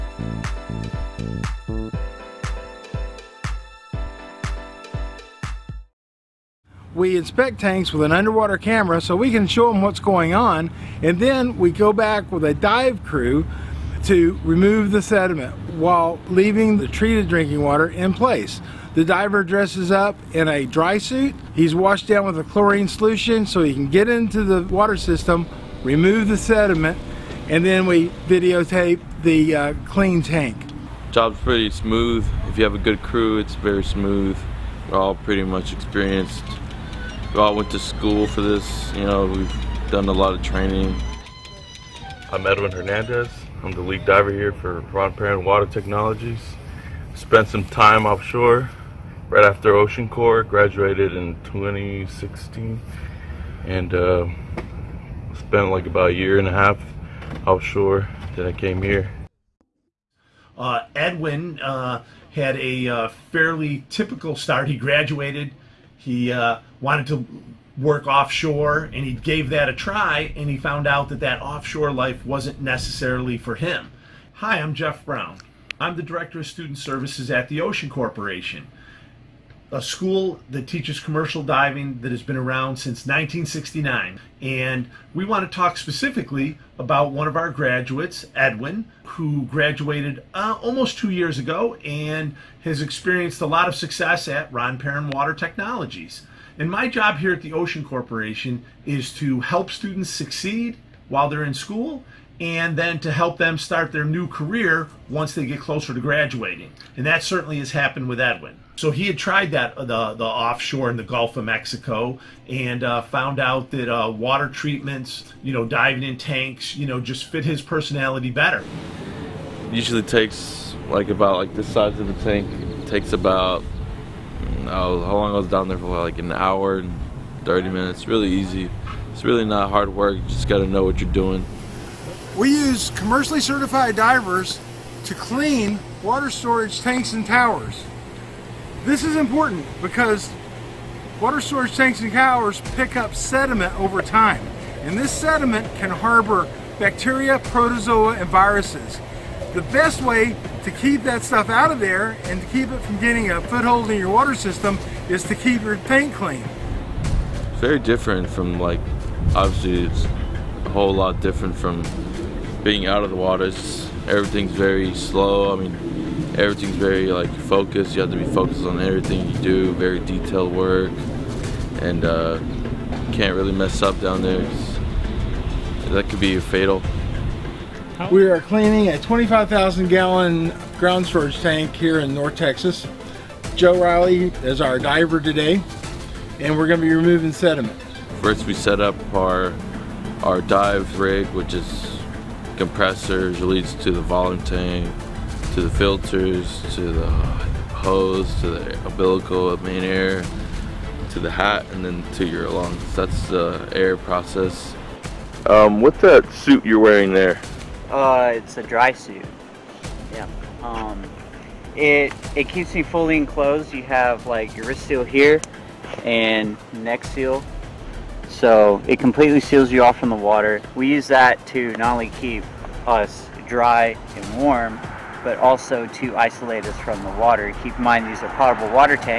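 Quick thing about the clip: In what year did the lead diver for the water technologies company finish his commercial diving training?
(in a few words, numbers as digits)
2016.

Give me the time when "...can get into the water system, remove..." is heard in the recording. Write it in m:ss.
0:23.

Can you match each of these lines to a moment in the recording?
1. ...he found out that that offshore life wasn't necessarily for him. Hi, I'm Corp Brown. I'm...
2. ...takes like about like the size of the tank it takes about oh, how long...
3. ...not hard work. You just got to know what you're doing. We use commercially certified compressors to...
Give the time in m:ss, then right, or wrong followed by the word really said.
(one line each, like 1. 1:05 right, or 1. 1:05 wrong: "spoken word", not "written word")
1. 1:10 wrong: "Jeff", not "Corp"
2. 2:00 right
3. 2:09 wrong: "divers", not "compressors".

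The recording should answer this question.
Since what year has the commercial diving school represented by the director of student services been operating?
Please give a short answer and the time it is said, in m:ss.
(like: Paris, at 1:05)
1969, at 1:23.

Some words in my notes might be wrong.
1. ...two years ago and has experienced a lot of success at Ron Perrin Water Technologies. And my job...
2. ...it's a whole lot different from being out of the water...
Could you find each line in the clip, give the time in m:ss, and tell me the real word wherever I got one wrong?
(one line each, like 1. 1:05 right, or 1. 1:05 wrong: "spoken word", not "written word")
1. 1:30 right
2. 2:39 right.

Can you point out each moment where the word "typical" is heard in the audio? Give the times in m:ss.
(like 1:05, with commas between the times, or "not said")
1:03.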